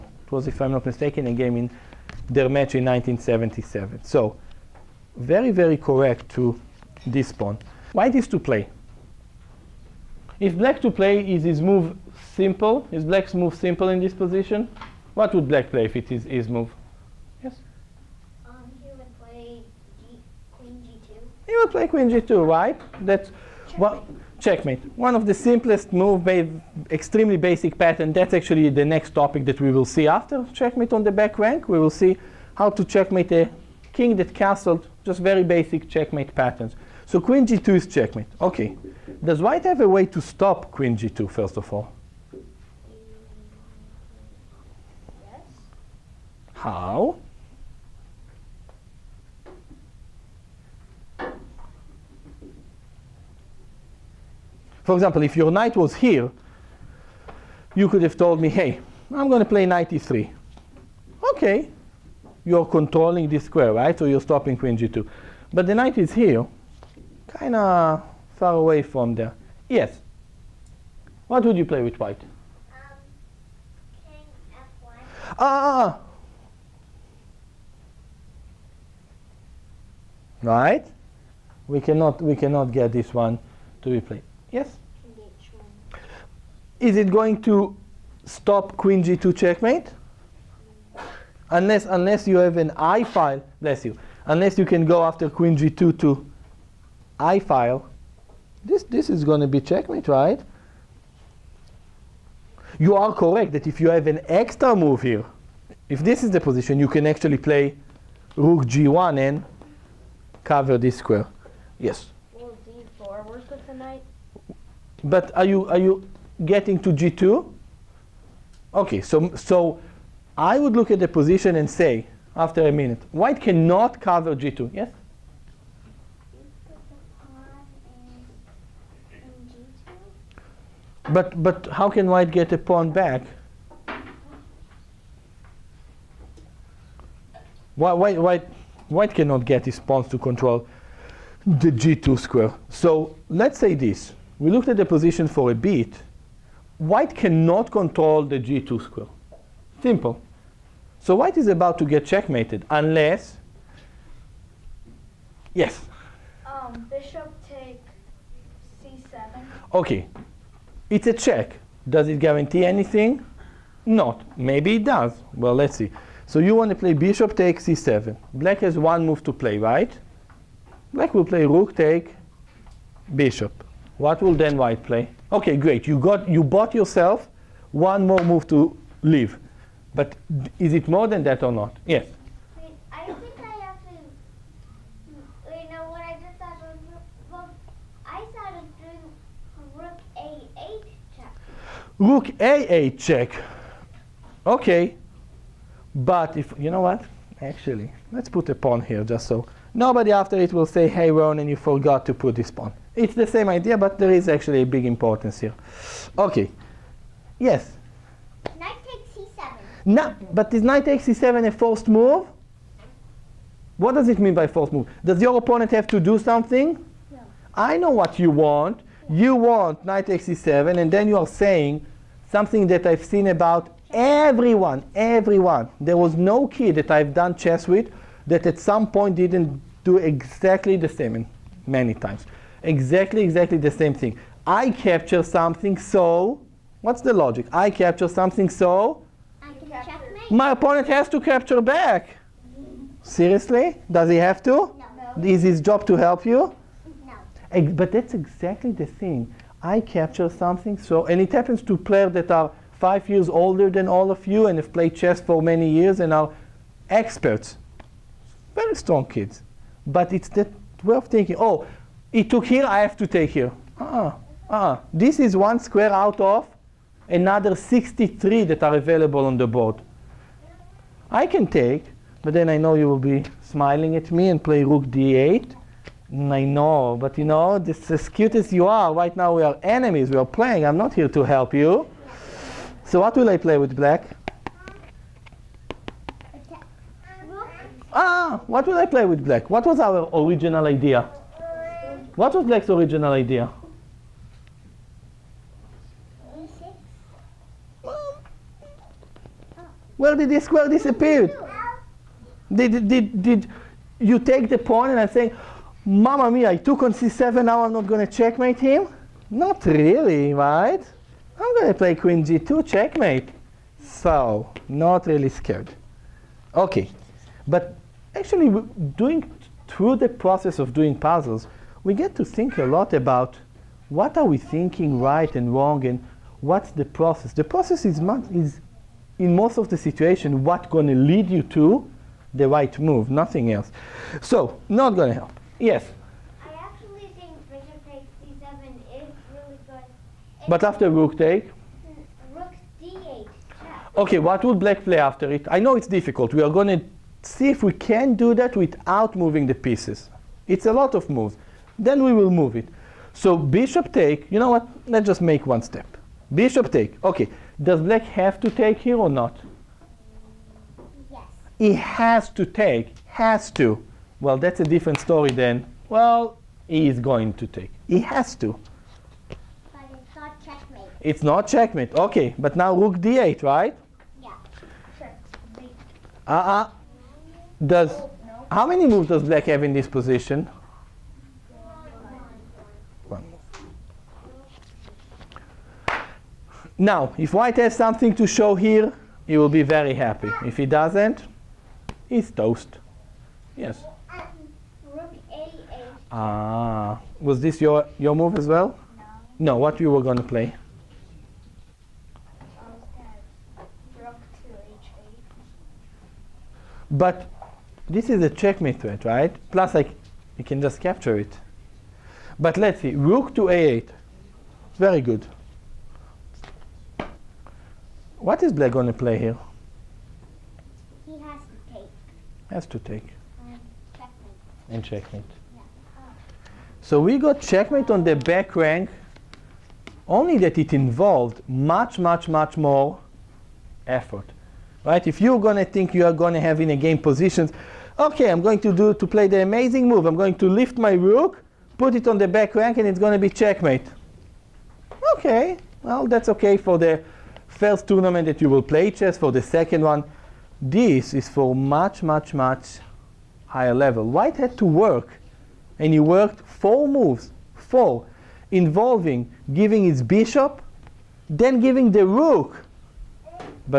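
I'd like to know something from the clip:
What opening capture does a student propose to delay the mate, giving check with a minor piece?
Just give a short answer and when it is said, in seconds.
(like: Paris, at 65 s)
Bishop takes c7, at 166 s.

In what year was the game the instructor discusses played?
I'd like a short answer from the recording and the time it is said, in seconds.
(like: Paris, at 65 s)
1977, at 2 s.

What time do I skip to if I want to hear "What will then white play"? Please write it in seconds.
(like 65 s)
174 s.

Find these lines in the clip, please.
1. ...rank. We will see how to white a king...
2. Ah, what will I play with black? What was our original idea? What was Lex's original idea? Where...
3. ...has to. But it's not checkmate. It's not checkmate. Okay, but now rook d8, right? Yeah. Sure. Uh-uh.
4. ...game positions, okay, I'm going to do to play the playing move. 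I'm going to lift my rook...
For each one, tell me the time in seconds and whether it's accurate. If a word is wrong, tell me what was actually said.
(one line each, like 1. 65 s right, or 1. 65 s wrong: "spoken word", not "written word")
1. 31 s wrong: "checkmate", not "white"
2. 287 s right
3. 368 s right
4. 436 s wrong: "amazing", not "playing".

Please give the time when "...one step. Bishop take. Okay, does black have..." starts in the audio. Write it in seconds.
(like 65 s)
355 s.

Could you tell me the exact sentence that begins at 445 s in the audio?
Okay, well, that's okay for the first tournament that you will play chess, for the second one.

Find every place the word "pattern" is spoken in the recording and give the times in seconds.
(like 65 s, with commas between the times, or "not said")
27 s, 36 s.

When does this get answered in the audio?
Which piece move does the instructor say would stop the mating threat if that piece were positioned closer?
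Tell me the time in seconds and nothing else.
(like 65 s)
59 s.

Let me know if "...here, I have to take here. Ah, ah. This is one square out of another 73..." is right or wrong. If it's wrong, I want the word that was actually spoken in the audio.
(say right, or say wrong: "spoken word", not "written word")
wrong: "63", not "73".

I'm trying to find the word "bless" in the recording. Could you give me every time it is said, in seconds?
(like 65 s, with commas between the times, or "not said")
93 s.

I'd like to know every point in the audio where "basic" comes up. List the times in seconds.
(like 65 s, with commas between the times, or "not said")
27 s, 35 s.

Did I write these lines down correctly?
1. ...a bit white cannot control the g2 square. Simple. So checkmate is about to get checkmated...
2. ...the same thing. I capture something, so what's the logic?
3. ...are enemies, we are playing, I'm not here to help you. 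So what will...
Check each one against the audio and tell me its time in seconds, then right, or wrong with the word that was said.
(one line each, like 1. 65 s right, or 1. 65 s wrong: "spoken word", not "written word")
1. 145 s wrong: "white", not "checkmate"
2. 233 s right
3. 279 s right.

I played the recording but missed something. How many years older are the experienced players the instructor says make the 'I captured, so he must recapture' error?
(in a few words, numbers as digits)
5.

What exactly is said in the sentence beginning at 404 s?
Rook to 8 But this is a checkmate threat, right?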